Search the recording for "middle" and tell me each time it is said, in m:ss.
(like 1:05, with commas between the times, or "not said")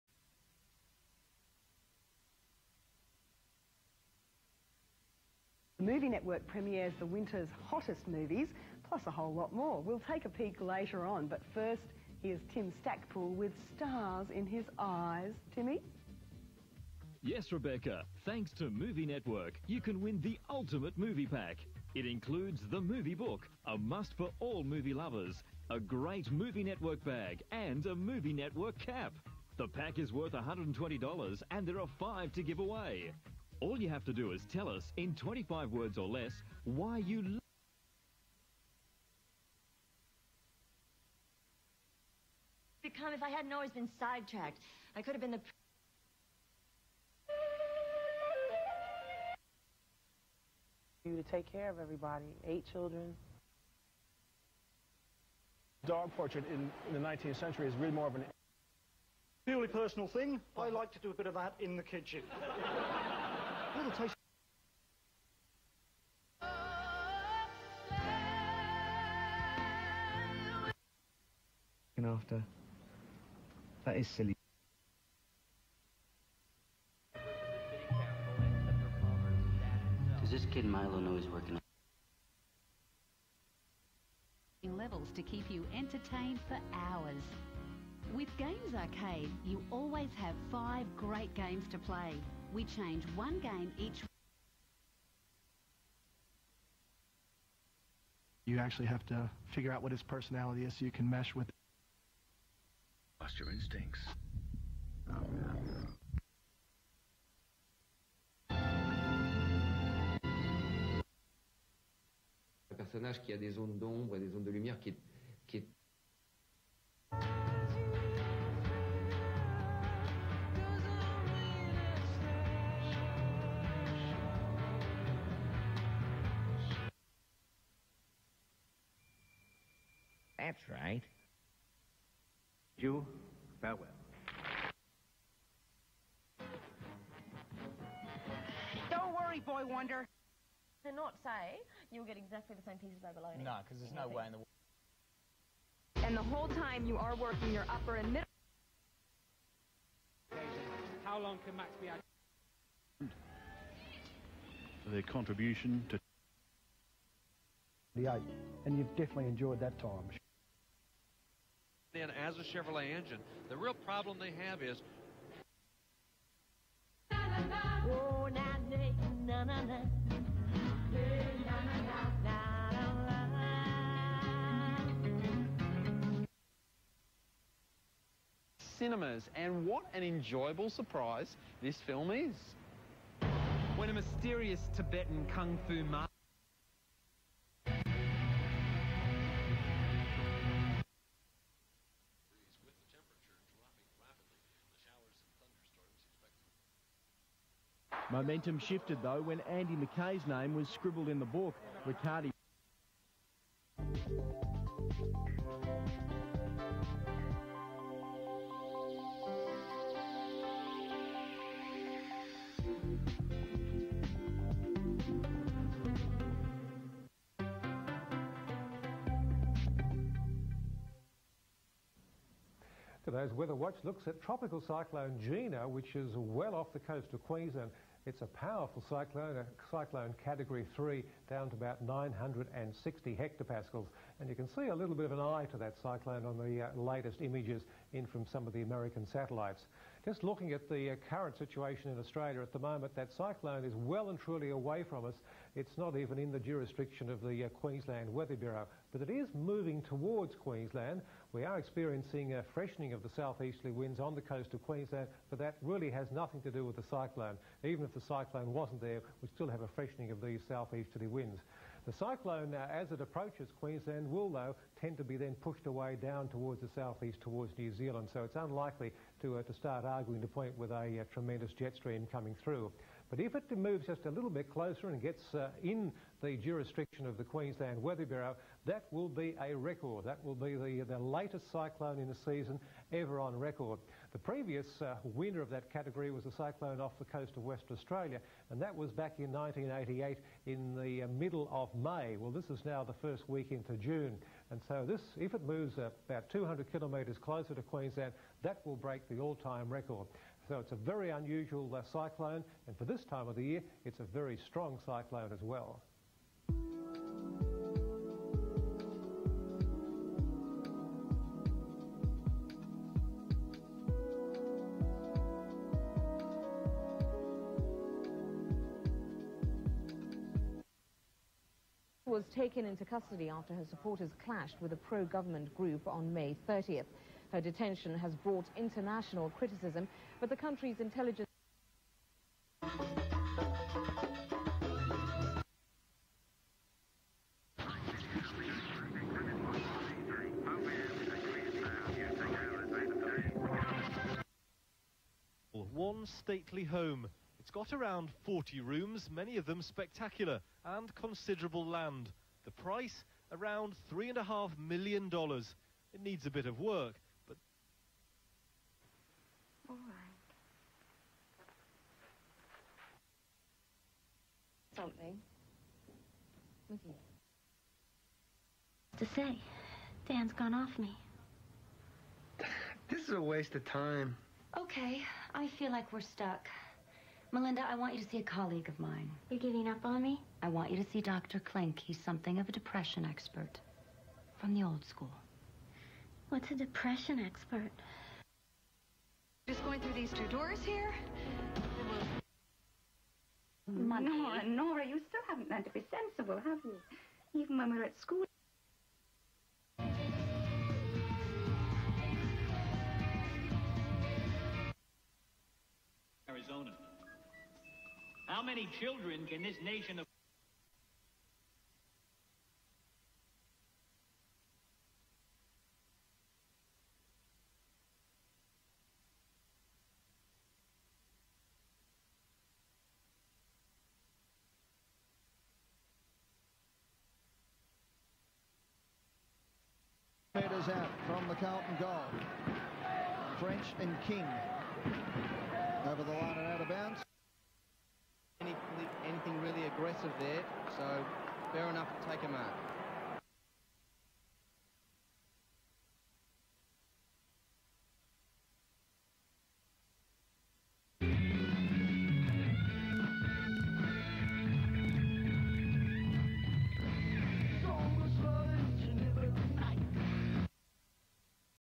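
2:28, 4:51.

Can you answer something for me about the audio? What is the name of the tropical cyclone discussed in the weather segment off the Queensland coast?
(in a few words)
Gina.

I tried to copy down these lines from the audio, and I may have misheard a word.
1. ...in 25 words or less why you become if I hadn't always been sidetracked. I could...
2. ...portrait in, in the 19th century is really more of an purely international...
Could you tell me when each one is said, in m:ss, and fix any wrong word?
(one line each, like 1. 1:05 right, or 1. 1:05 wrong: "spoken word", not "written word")
1. 0:34 right
2. 0:56 wrong: "personal", not "international".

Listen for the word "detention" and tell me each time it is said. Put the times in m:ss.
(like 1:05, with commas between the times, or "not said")
5:27.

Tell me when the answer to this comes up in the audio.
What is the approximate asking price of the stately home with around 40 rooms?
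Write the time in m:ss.
5:53.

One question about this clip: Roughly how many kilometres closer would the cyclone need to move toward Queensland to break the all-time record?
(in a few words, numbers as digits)
200 kilometres.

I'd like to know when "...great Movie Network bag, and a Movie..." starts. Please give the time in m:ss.
0:25.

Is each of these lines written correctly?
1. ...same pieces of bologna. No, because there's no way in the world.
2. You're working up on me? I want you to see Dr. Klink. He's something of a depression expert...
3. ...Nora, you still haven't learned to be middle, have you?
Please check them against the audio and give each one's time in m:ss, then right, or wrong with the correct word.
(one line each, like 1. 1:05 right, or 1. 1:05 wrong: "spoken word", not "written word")
1. 2:22 right
2. 6:19 wrong: "giving", not "working"
3. 6:34 wrong: "sensible", not "middle".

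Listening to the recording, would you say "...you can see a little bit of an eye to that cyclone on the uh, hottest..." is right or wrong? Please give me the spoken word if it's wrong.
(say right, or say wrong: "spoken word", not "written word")
wrong: "latest", not "hottest".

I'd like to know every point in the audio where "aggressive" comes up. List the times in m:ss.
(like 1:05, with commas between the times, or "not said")
7:19.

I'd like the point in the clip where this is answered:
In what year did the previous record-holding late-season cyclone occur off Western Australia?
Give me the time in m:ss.
4:49.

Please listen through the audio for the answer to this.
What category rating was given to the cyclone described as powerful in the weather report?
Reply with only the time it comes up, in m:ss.
3:50.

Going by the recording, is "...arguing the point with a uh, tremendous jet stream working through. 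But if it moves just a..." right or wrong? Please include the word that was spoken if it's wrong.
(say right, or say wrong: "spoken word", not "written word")
wrong: "coming", not "working".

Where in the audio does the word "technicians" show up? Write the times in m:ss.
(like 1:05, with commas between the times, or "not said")
not said.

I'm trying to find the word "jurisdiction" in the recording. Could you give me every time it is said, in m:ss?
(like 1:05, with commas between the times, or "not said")
4:06, 4:36.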